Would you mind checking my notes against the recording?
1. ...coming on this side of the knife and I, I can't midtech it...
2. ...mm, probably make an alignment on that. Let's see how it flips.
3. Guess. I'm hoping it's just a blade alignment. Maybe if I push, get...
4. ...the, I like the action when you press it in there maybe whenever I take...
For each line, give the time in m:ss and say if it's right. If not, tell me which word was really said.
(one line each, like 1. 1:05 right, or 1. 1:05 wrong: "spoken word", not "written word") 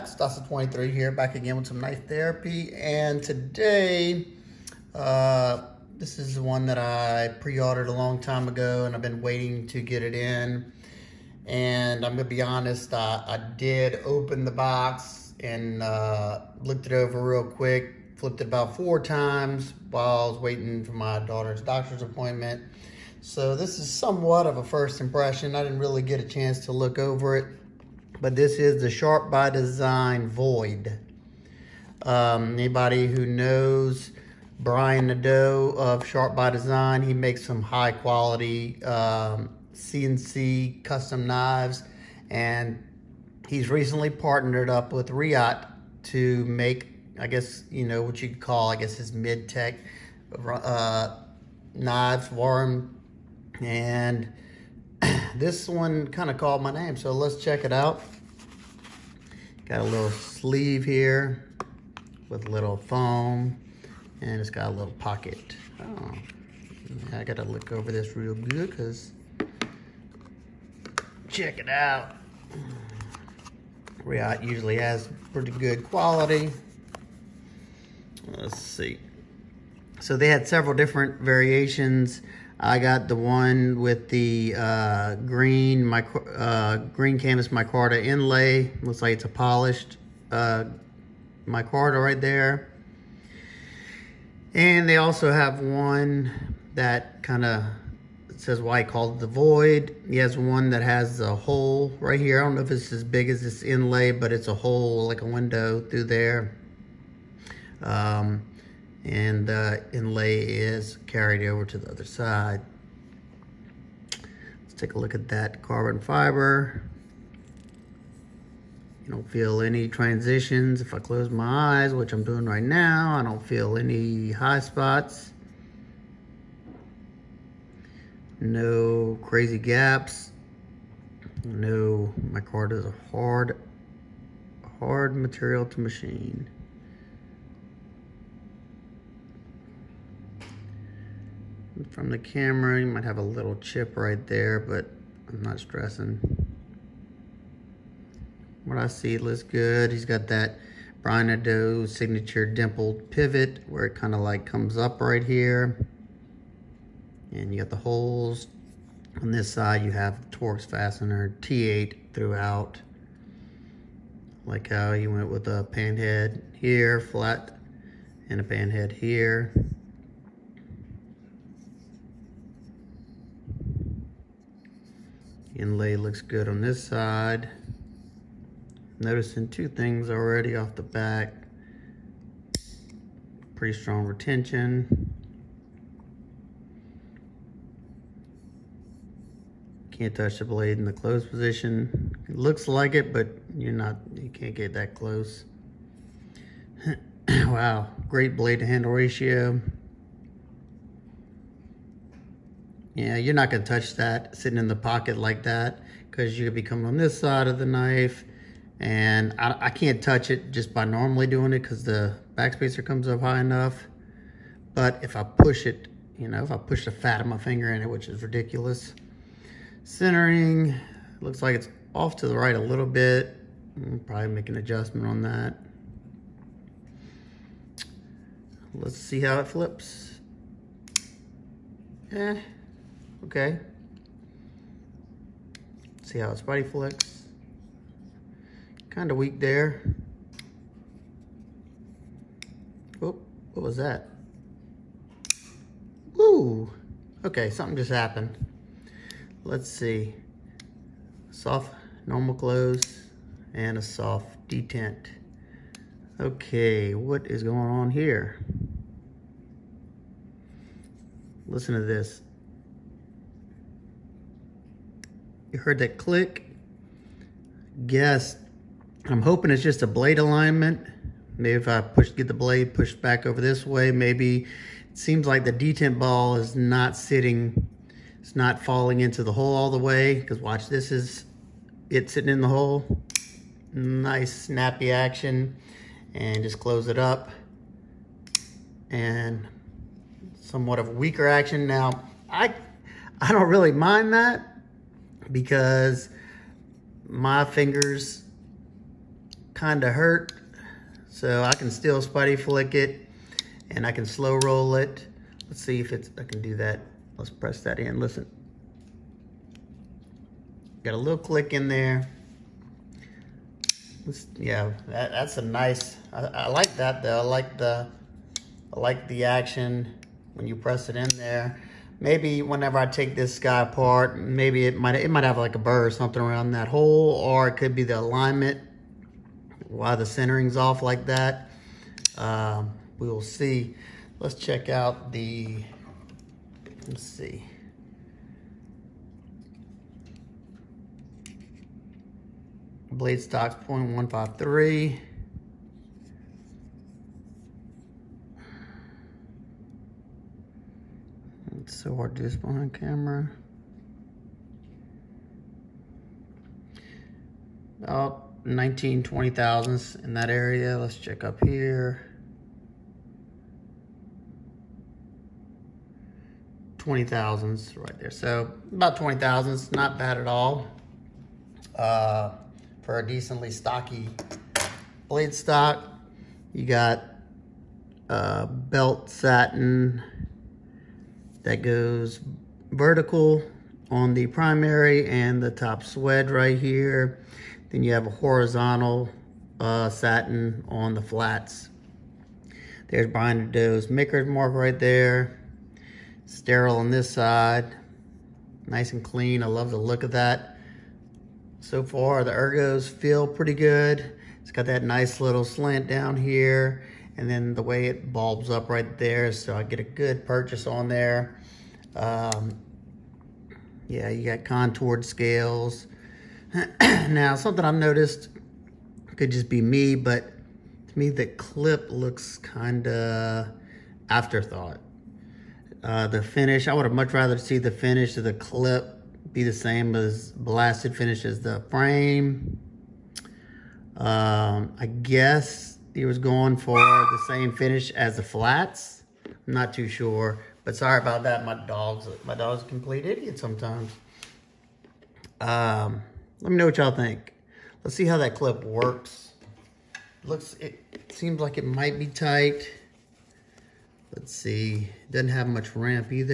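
1. 3:26 wrong: "touch", not "midtech"
2. 3:43 wrong: "adjustment", not "alignment"
3. 4:27 right
4. 5:17 right.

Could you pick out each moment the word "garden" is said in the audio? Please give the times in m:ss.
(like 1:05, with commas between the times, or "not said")
not said.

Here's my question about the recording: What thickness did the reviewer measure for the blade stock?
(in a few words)
0.153.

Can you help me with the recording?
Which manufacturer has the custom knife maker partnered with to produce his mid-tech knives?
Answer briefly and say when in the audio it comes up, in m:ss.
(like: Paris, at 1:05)
Riot, at 0:45.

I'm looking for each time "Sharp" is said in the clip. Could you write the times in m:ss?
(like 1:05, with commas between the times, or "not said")
0:28, 0:36.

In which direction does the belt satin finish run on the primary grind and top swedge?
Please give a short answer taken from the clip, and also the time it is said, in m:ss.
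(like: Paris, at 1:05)
Vertical, at 6:22.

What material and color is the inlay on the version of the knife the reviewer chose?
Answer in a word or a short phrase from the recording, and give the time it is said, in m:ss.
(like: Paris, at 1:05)
Green canvas micarta, at 1:26.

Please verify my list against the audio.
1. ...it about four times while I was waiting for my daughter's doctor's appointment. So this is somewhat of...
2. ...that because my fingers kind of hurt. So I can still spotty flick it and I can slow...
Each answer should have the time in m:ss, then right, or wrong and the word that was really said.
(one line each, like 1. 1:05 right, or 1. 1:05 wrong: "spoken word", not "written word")
1. 0:18 right
2. 4:54 right.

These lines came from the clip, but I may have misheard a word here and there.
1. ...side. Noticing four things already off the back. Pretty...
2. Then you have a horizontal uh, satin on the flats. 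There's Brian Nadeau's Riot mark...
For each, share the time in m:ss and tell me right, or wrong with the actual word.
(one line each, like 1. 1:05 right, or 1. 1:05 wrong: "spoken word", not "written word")
1. 2:56 wrong: "two", not "four"
2. 6:27 wrong: "Mickard", not "Riot".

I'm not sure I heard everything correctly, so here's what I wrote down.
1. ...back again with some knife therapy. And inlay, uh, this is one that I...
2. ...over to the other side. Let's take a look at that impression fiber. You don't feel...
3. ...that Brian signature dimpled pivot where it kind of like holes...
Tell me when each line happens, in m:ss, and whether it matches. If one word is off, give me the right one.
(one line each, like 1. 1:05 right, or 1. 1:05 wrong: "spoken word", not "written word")
1. 0:01 wrong: "today", not "inlay"
2. 1:51 wrong: "carbon", not "impression"
3. 2:30 wrong: "comes", not "holes".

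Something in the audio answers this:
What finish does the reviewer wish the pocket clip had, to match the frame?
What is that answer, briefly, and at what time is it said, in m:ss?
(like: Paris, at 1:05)
Blasted finish, at 7:10.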